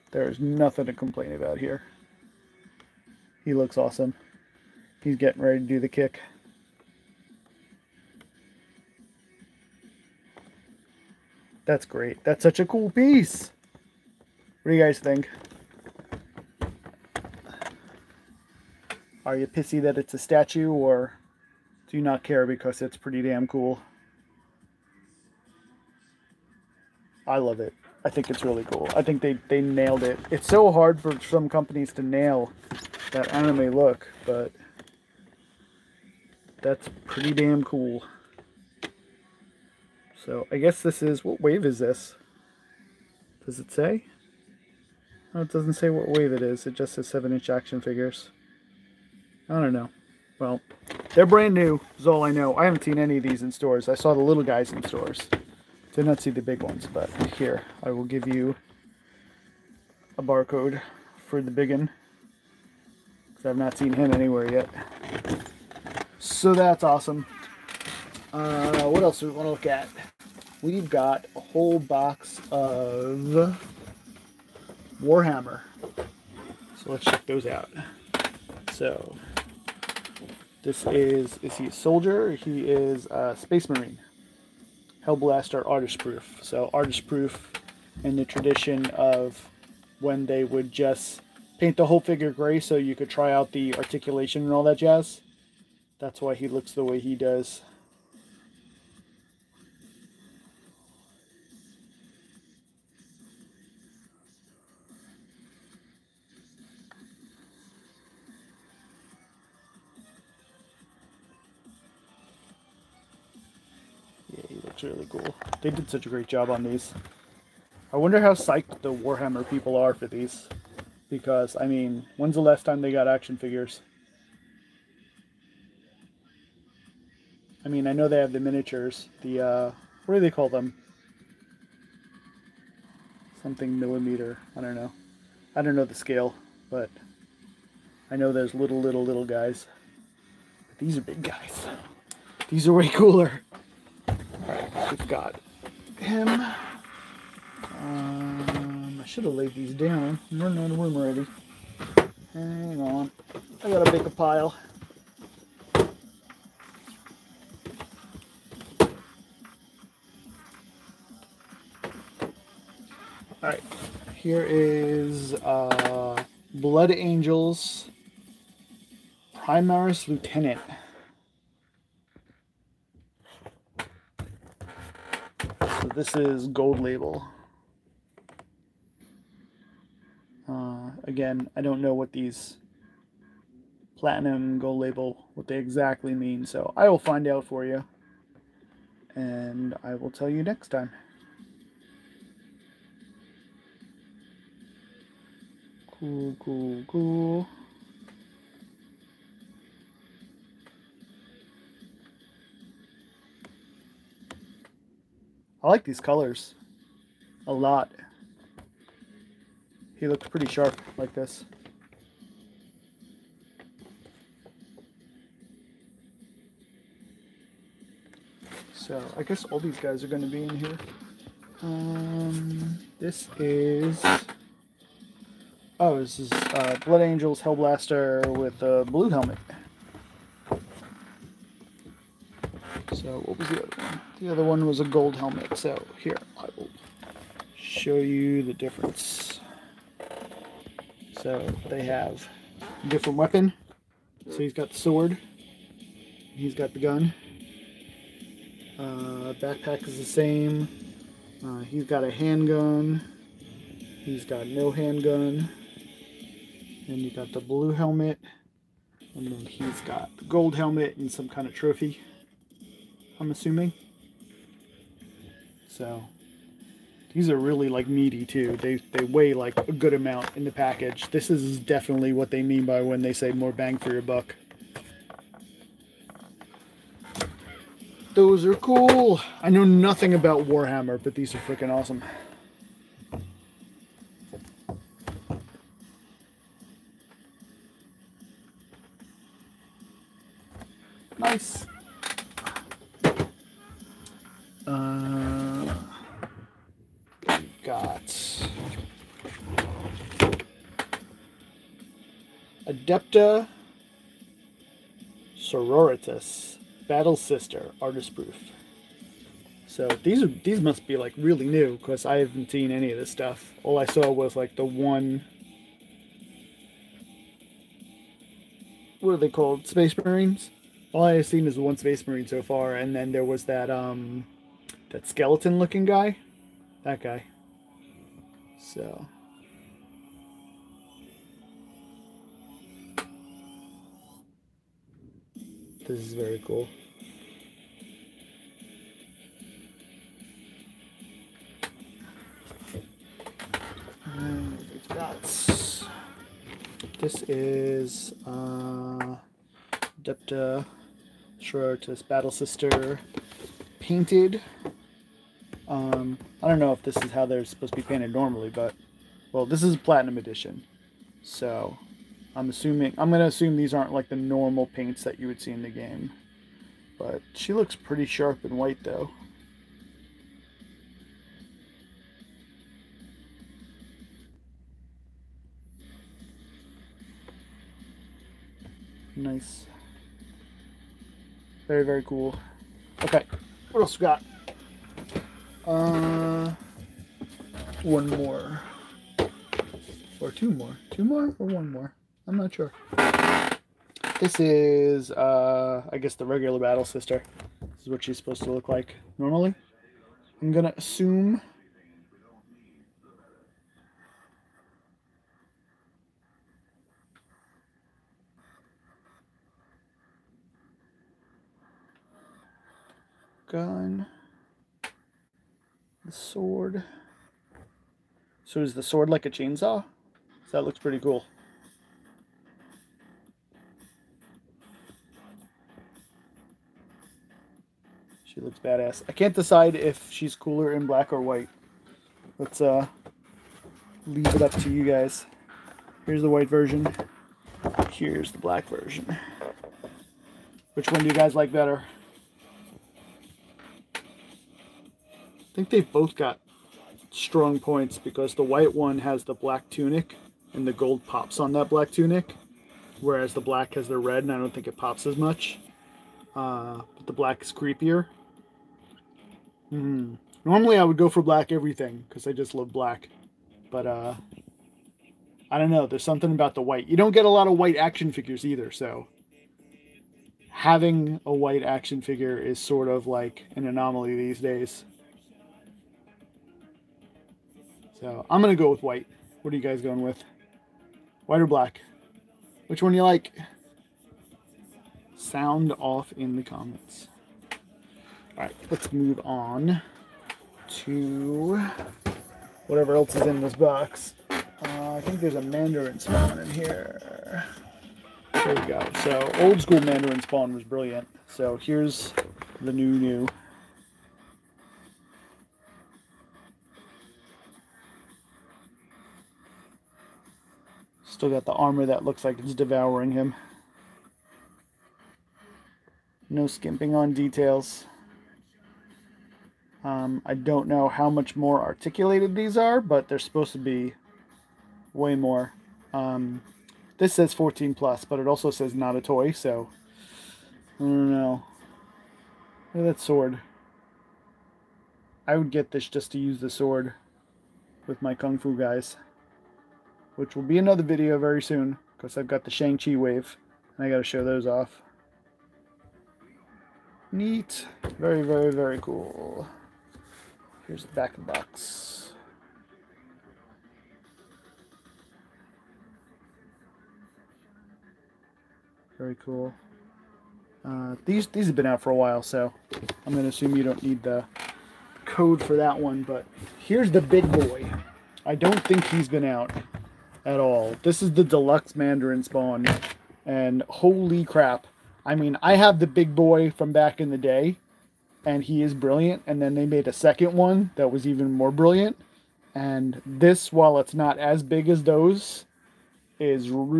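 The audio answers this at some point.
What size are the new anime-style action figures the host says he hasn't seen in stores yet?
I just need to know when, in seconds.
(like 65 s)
47 s.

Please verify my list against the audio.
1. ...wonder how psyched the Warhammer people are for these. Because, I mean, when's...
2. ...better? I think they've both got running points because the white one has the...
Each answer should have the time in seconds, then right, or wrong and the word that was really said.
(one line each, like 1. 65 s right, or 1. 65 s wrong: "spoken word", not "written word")
1. 117 s right
2. 441 s wrong: "strong", not "running".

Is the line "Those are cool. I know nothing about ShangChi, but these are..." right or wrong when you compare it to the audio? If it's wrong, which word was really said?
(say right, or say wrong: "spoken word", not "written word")
wrong: "Warhammer", not "ShangChi".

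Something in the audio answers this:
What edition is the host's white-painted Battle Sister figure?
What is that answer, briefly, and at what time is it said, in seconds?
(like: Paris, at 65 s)
platinum edition, at 359 s.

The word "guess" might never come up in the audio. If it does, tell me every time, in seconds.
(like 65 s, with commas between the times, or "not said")
40 s, 219 s, 395 s.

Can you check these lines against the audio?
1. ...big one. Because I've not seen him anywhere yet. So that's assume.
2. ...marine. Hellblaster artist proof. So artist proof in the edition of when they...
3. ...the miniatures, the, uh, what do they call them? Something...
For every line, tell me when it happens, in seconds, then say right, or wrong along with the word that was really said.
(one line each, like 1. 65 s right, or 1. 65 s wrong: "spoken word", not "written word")
1. 61 s wrong: "awesome", not "assume"
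2. 83 s wrong: "tradition", not "edition"
3. 128 s right.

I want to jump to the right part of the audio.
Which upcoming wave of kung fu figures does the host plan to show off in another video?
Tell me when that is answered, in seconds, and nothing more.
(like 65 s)
542 s.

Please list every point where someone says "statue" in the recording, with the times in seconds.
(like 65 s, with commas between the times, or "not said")
20 s.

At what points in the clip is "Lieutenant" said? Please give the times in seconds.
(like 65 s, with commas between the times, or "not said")
170 s.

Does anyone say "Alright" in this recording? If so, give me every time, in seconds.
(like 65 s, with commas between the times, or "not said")
144 s, 163 s.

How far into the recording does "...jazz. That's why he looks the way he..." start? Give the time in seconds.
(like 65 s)
94 s.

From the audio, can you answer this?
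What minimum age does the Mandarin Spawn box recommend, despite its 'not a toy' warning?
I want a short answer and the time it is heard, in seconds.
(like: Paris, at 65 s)
14+, at 527 s.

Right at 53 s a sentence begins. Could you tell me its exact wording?
I saw the little guys in stores.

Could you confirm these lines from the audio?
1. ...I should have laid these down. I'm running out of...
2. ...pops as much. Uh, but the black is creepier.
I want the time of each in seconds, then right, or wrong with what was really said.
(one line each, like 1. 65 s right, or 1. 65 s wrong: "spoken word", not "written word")
1. 149 s right
2. 454 s right.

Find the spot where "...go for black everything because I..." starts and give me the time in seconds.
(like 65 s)
460 s.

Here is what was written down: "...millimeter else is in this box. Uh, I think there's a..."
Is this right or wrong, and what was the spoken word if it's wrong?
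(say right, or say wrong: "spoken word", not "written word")
wrong: "whatever", not "millimeter".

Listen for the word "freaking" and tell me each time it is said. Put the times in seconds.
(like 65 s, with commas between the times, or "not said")
281 s.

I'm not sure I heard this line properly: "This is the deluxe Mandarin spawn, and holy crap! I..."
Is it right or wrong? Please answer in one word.
right.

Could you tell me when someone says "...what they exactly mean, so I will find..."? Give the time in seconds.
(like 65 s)
185 s.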